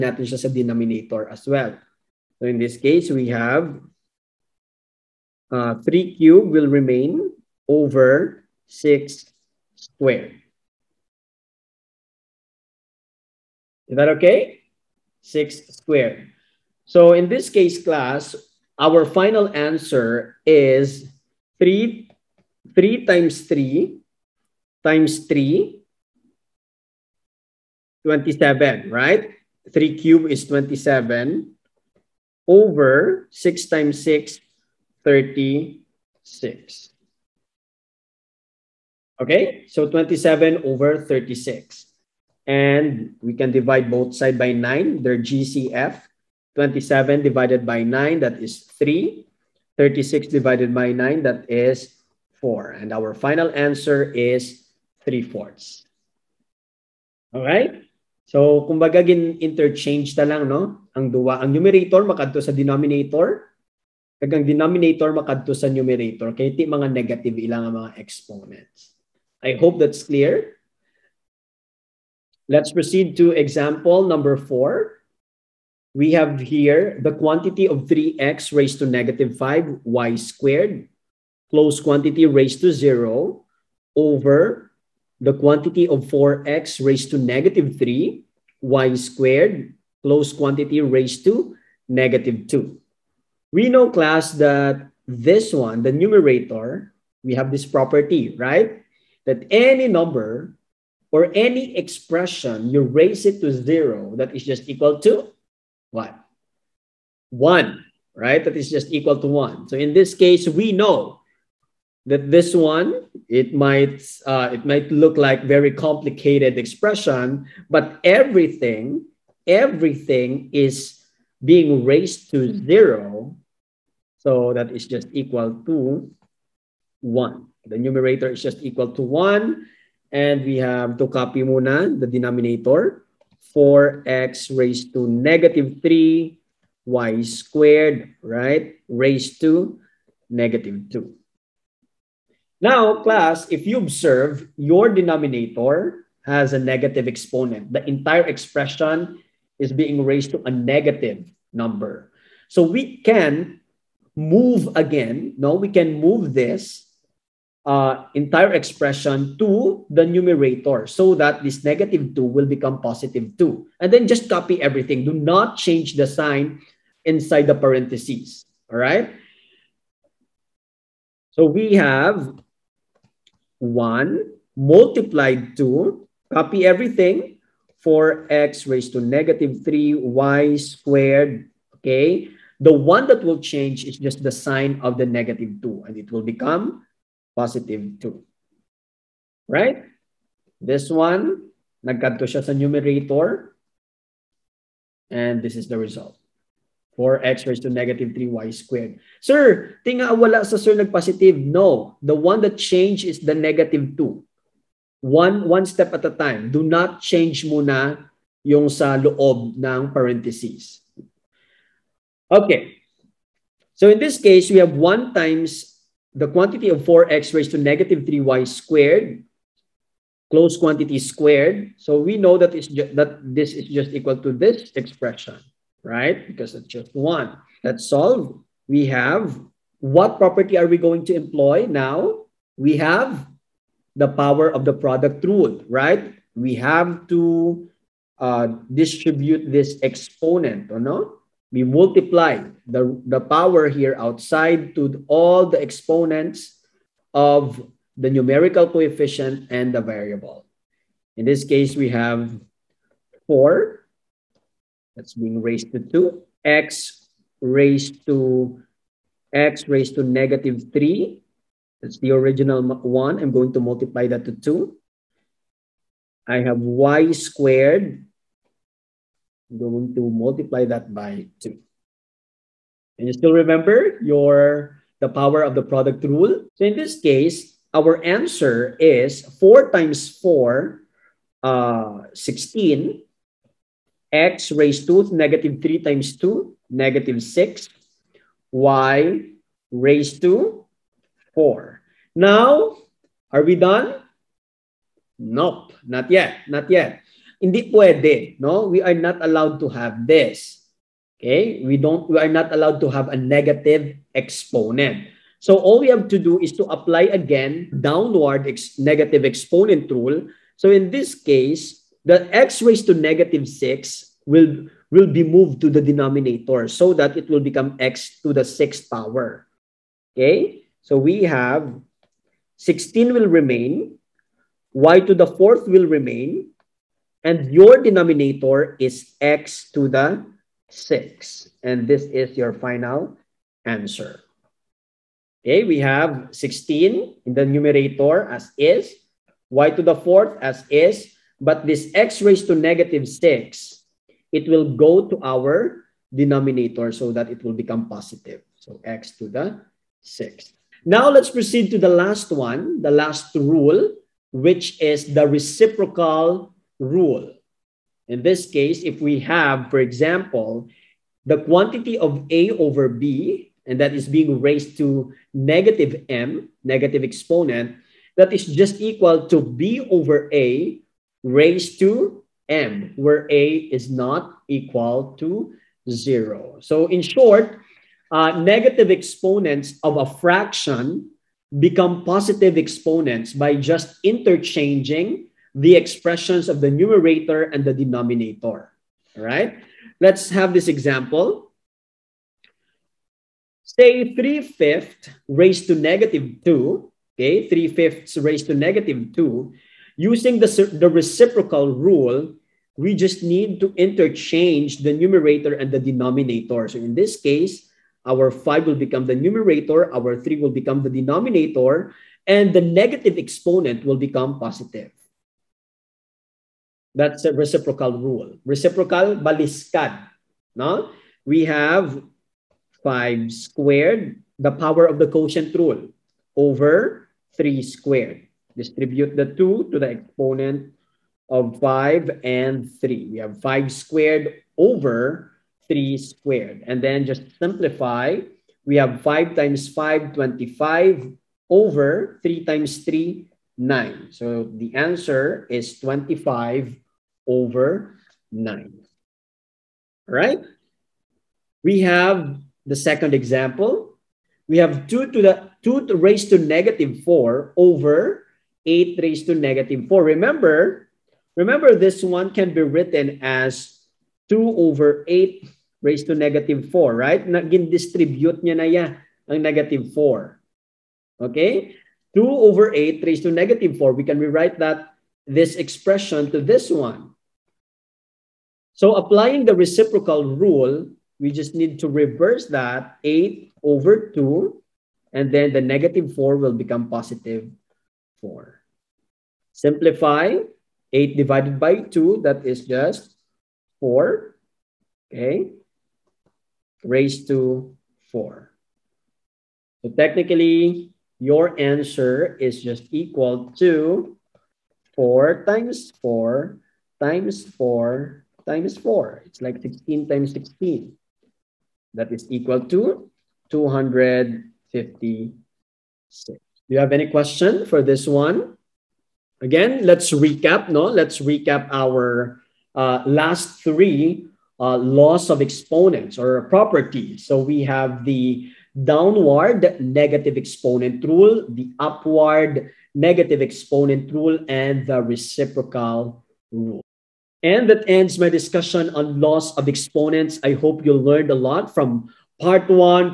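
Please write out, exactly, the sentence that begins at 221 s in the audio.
So we know that, it's that this is just equal to this expression, right?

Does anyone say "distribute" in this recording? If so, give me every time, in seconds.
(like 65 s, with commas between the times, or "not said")
238 s, 428 s, 467 s.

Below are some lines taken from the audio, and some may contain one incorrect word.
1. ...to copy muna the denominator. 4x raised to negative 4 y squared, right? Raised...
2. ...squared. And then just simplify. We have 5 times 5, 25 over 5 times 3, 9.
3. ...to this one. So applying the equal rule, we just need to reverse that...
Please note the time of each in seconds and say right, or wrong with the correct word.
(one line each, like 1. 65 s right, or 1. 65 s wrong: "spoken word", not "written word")
1. 130 s wrong: "3", not "4"
2. 435 s wrong: "3", not "5"
3. 476 s wrong: "reciprocal", not "equal".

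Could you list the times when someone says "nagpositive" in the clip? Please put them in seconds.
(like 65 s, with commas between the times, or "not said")
200 s.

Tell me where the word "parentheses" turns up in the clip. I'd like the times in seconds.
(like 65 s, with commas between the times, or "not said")
167 s, 209 s.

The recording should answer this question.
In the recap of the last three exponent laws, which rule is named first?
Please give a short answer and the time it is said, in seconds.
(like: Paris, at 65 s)
downward negative exponent rule, at 528 s.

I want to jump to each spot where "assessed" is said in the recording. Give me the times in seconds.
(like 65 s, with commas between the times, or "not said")
not said.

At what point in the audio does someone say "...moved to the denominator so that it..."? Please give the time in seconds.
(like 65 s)
315 s.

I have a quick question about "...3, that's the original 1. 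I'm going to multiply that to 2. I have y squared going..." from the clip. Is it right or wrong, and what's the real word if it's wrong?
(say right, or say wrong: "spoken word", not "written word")
right.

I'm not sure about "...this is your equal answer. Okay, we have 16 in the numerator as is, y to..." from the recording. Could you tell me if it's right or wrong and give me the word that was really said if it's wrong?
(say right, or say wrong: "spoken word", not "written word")
wrong: "final", not "equal".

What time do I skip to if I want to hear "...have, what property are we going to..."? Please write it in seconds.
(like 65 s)
228 s.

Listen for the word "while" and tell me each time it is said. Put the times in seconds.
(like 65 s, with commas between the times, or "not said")
not said.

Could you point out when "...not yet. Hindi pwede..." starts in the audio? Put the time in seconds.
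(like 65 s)
296 s.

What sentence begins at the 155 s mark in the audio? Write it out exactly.
No, we can move this uh, entire expression to the numerator so that this negative 2 will become positive 2.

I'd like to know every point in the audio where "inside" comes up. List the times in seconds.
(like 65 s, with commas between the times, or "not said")
167 s.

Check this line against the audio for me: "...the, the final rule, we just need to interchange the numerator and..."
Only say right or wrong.
wrong.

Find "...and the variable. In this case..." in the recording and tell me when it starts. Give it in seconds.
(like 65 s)
249 s.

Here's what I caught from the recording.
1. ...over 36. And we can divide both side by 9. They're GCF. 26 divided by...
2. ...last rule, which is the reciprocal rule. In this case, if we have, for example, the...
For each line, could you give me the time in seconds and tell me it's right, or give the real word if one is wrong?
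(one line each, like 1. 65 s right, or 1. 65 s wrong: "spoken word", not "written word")
1. 40 s wrong: "27", not "26"
2. 352 s right.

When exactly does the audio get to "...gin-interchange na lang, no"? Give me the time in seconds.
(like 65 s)
59 s.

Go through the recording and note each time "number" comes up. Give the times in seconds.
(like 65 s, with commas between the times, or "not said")
74 s, 99 s, 151 s.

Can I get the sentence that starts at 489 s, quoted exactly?
Simplify 8 divided by 2, that is just 4, okay, raised to 4.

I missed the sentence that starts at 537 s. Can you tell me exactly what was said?
And that ends my discussion on laws of exponents.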